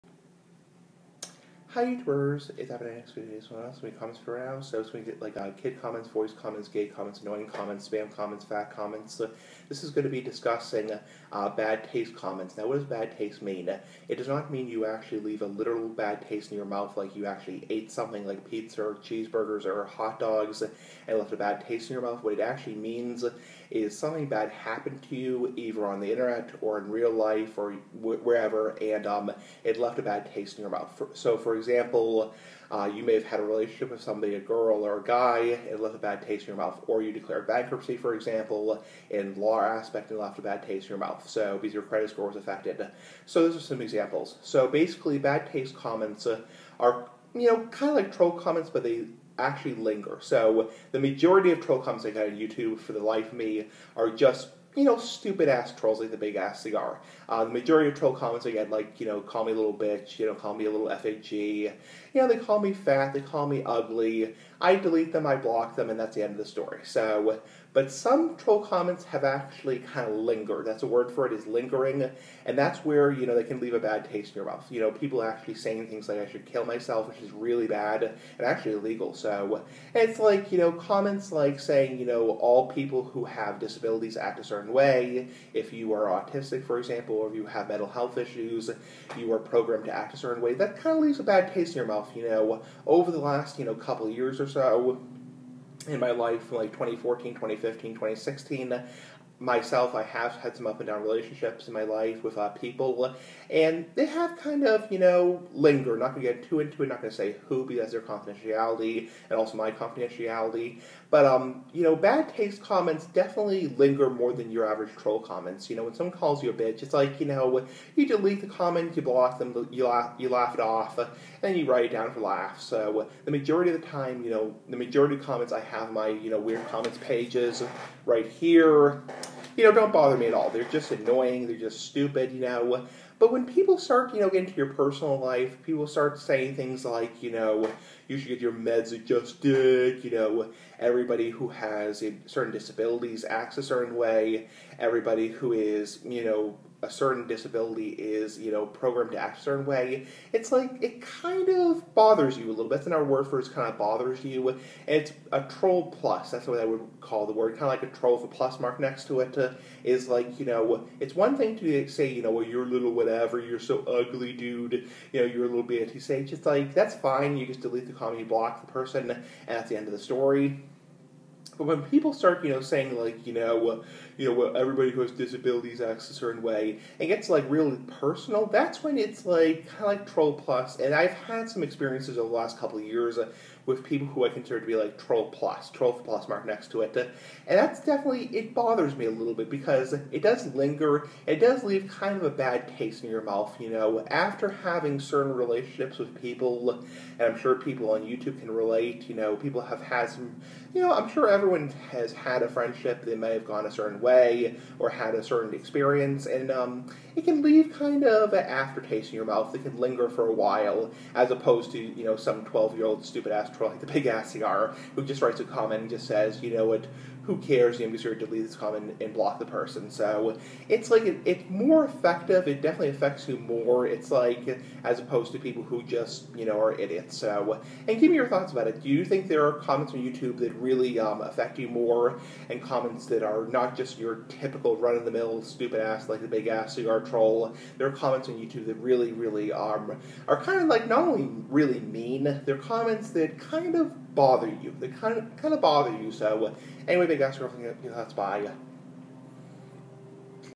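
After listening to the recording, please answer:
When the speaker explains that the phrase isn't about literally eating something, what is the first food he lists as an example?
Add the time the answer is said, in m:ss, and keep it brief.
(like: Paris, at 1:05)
pizza, at 0:18.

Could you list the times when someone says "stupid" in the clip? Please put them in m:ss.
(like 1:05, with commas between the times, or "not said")
0:54, 2:11, 3:33, 3:55.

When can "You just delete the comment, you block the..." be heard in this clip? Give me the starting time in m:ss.
2:47.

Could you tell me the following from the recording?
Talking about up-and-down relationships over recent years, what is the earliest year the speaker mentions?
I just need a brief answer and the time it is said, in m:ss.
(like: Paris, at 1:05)
2014, at 1:36.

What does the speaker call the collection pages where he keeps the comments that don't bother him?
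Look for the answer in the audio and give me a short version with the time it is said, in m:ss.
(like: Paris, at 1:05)
weird comments pages, at 2:06.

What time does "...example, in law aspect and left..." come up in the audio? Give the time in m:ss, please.
0:38.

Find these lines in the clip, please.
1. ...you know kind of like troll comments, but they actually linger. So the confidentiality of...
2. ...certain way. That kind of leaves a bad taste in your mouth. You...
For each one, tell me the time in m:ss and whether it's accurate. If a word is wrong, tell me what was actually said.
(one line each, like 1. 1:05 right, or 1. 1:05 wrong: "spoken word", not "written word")
1. 0:47 wrong: "majority", not "confidentiality"
2. 1:30 right.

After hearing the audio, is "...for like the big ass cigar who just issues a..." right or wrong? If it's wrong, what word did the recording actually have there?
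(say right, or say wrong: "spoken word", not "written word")
wrong: "writes", not "issues".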